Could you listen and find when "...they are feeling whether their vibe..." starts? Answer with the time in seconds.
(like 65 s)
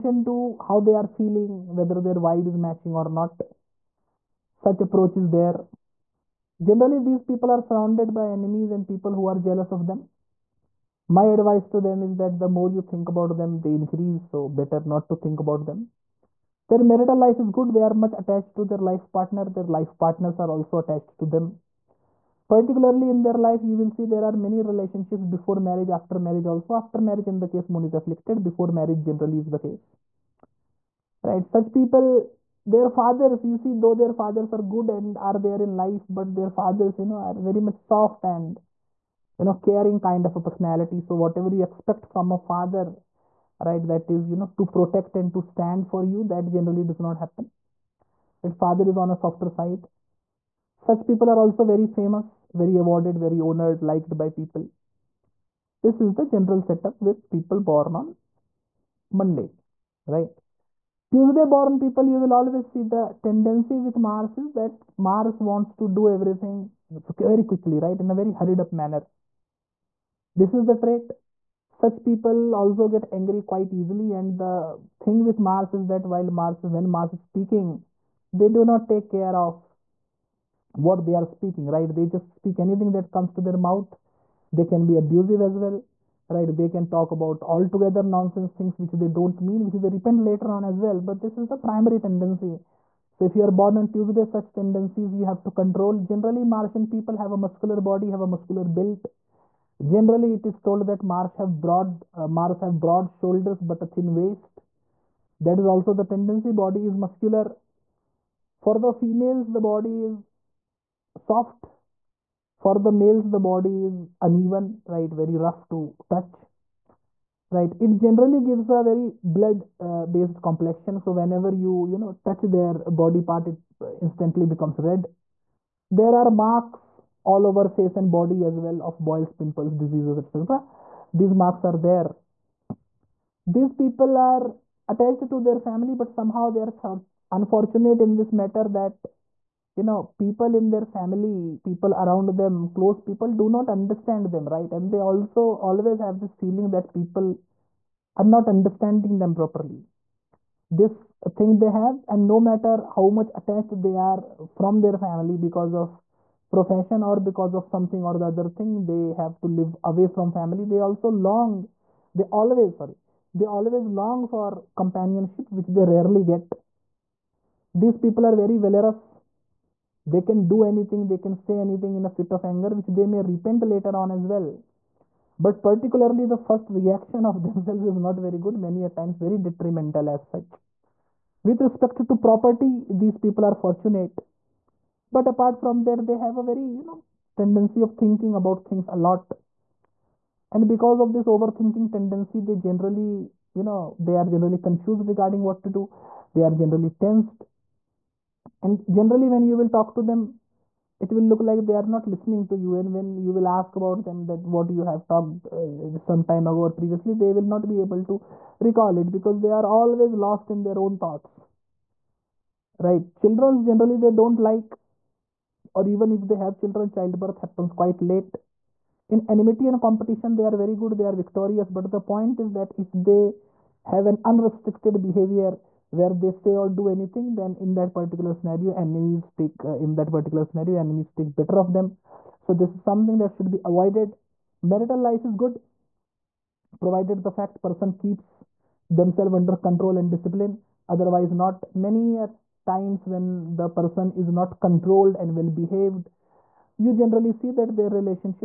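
0 s.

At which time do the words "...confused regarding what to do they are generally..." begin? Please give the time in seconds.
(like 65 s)
194 s.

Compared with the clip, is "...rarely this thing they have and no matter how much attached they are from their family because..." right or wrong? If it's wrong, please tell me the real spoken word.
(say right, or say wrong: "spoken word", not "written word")
wrong: "properly", not "rarely".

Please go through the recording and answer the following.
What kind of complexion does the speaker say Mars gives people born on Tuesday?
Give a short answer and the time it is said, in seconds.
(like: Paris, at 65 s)
Blood-based, at 119 s.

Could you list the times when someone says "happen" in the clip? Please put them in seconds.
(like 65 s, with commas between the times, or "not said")
47 s, 217 s.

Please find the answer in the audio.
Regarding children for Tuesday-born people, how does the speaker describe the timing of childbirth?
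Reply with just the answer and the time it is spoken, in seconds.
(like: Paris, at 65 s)
Quite late, at 217 s.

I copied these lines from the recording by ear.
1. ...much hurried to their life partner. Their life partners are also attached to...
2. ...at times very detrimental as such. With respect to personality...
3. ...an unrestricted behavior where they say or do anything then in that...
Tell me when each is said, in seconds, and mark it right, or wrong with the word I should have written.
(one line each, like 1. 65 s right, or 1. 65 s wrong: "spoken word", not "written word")
1. 17 s wrong: "attached", not "hurried"
2. 178 s wrong: "property", not "personality"
3. 224 s right.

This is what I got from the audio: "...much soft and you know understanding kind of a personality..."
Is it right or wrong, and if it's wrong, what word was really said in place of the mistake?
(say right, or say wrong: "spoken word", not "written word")
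wrong: "caring", not "understanding".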